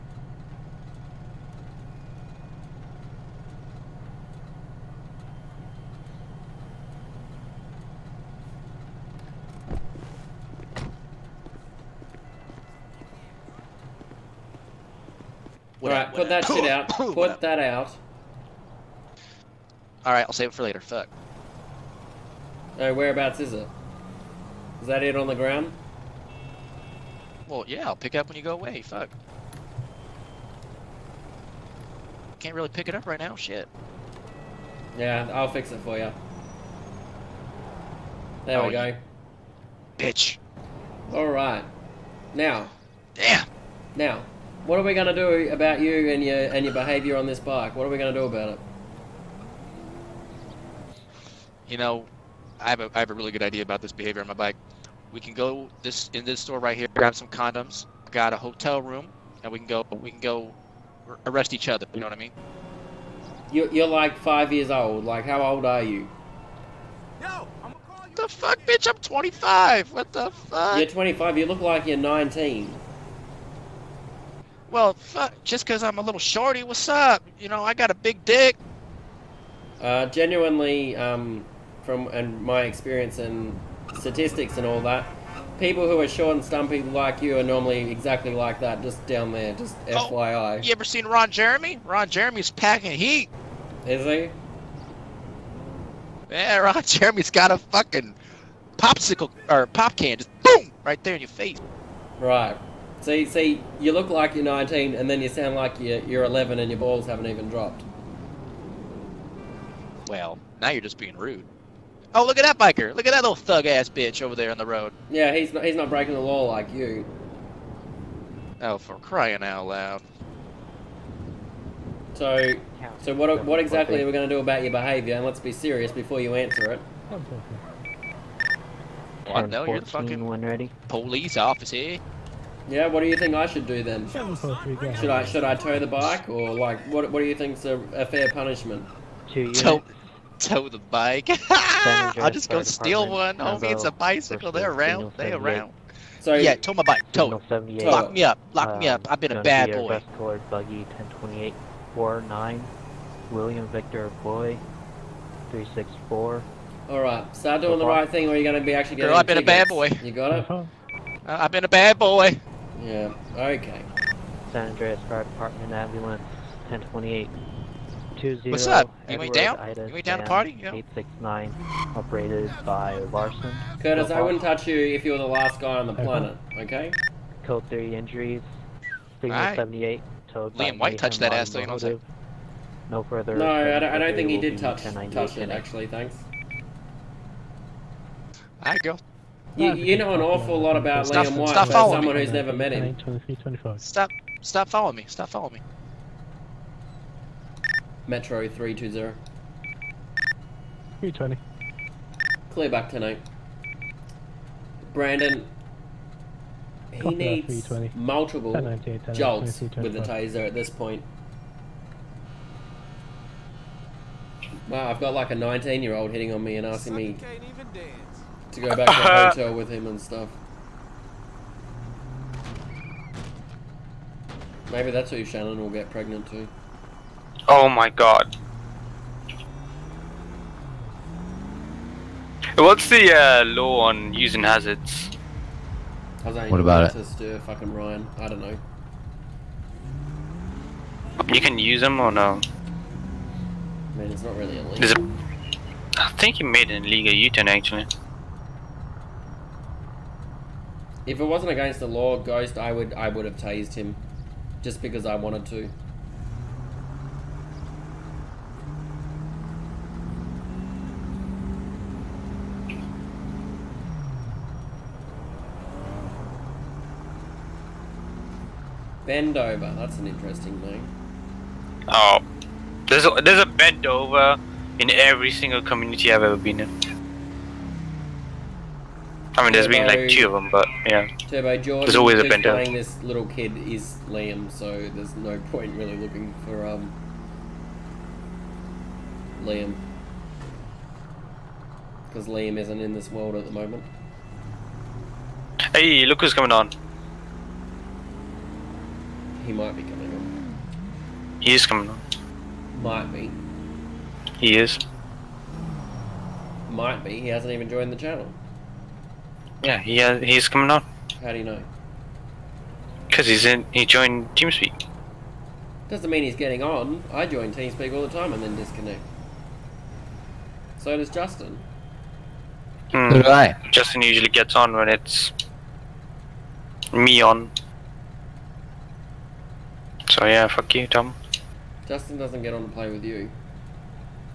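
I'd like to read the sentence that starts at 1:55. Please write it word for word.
Yeah, he's not, he's not breaking the law like you.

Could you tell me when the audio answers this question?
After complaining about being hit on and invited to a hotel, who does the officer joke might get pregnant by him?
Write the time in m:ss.
3:45.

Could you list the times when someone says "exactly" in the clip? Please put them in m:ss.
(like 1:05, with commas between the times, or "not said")
1:27, 2:03.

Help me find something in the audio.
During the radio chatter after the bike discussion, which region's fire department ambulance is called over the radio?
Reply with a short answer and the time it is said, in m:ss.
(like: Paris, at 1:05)
San Andreas, at 2:44.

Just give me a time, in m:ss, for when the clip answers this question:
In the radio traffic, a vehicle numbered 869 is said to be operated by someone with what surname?
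2:52.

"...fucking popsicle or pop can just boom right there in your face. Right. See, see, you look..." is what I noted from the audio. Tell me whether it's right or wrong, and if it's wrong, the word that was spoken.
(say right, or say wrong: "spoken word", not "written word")
right.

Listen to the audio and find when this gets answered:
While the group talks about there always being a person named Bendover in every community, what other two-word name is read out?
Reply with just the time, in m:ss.
4:41.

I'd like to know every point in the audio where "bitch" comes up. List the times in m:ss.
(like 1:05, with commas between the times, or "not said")
0:39, 1:08, 1:53.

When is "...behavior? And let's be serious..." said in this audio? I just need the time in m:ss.
2:04.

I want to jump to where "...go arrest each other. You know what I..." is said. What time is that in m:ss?
1:00.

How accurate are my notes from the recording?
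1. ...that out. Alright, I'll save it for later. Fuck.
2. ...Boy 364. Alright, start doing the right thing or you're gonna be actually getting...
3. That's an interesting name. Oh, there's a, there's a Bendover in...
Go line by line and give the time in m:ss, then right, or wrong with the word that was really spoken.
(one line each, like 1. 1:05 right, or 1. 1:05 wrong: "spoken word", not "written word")
1. 0:17 right
2. 2:34 right
3. 4:29 right.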